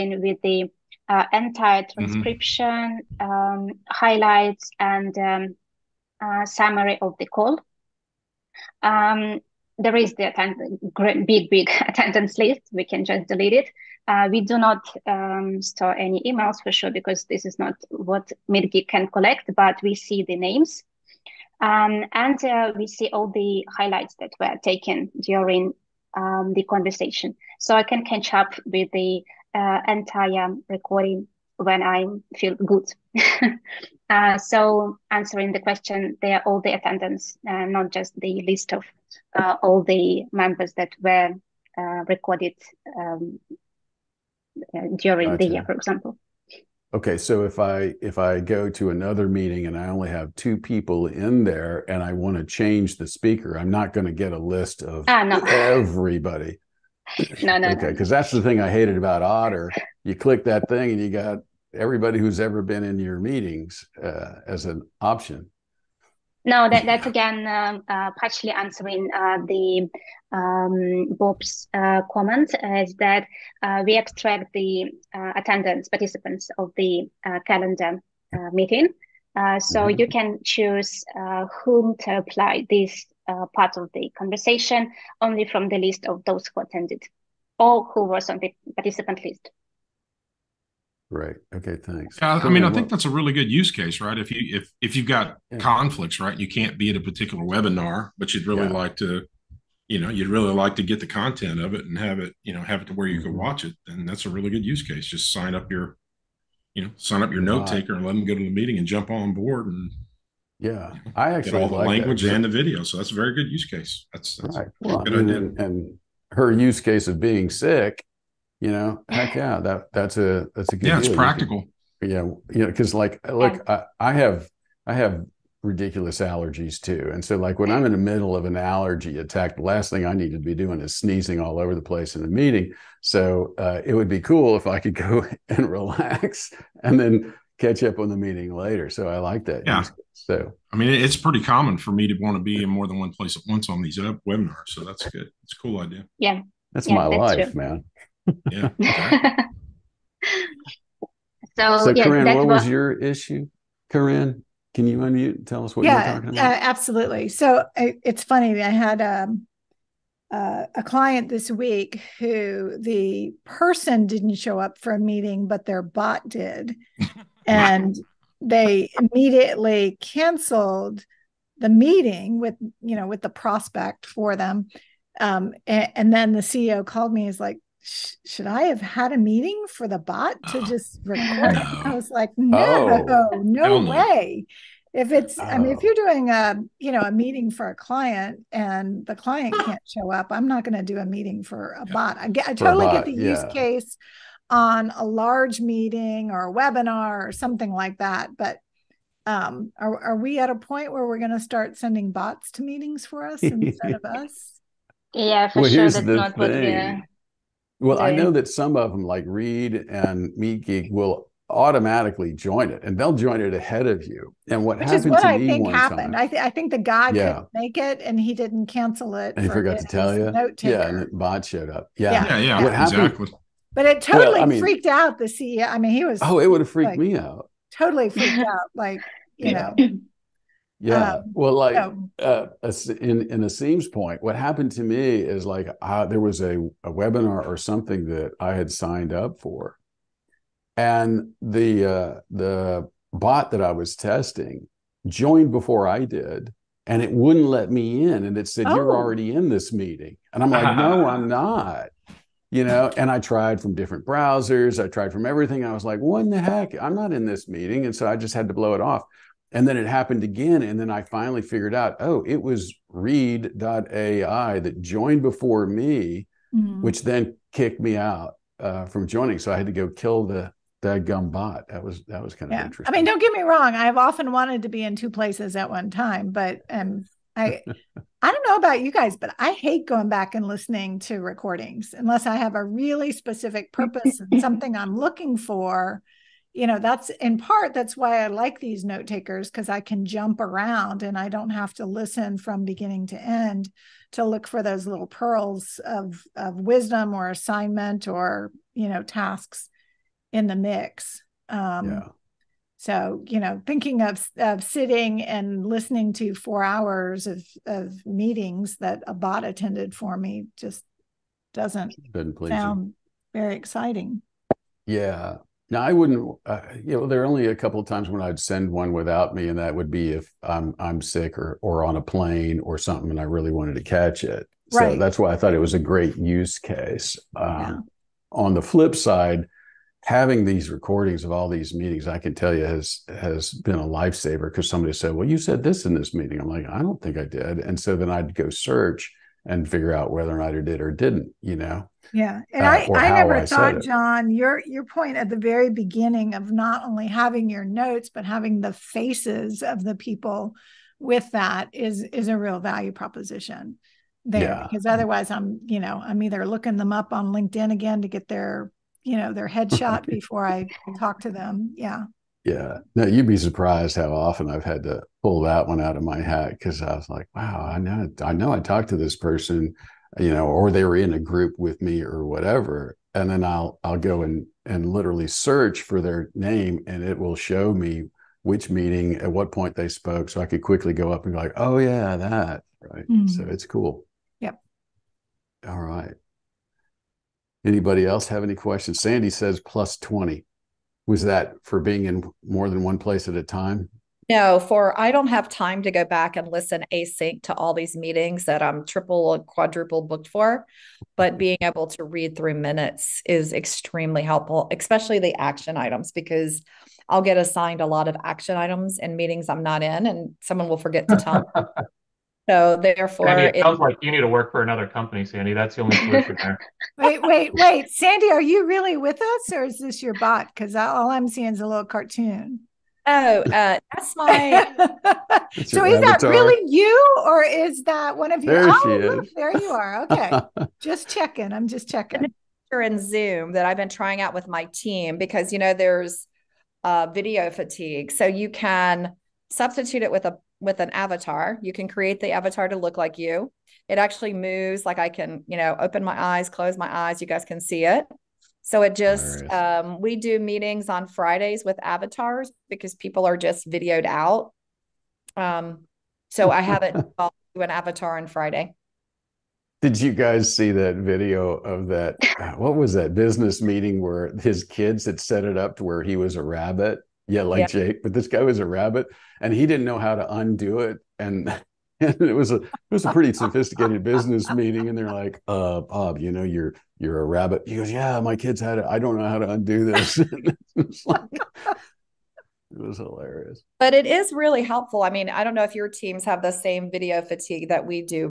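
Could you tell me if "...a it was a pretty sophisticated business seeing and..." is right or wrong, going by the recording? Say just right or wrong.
wrong.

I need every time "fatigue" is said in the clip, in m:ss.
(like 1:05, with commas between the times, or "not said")
7:17, 8:07.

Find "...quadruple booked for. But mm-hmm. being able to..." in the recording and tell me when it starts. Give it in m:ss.
6:39.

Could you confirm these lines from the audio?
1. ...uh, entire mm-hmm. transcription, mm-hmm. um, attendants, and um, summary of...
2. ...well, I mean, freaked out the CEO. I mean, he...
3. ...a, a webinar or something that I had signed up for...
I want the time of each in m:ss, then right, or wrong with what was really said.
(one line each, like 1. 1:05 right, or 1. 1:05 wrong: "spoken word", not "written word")
1. 0:01 wrong: "highlights", not "attendants"
2. 3:44 right
3. 3:56 right.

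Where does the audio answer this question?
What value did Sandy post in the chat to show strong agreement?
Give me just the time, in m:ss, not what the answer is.
6:29.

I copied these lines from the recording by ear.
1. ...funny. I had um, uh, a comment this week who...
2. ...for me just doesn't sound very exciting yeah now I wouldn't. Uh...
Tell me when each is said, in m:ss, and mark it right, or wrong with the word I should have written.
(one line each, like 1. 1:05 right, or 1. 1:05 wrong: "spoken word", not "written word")
1. 2:38 wrong: "client", not "comment"
2. 5:09 right.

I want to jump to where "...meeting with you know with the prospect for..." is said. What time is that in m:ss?
2:51.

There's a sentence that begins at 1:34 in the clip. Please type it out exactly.
If you if if you've got yeah.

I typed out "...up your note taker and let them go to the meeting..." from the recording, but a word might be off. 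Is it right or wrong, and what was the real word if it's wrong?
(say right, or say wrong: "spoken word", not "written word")
right.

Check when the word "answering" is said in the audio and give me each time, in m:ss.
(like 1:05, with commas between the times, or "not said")
0:35, 1:08.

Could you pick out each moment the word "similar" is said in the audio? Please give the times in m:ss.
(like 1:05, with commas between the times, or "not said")
not said.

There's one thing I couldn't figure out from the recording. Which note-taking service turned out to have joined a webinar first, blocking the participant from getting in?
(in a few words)
read.ai.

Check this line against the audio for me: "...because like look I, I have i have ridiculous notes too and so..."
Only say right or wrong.
wrong.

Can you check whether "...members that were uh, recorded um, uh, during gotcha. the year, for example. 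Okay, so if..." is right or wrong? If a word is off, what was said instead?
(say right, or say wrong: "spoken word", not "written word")
right.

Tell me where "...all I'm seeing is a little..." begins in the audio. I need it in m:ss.
7:00.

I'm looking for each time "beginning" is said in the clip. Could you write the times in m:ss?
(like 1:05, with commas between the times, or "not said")
4:52, 5:45.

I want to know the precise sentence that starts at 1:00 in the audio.
You click that thing and you got everybody who's ever been in your meetings uh, as an option.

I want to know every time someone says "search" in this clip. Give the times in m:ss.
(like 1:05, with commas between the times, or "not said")
5:38, 6:15.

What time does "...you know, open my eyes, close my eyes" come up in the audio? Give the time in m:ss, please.
7:25.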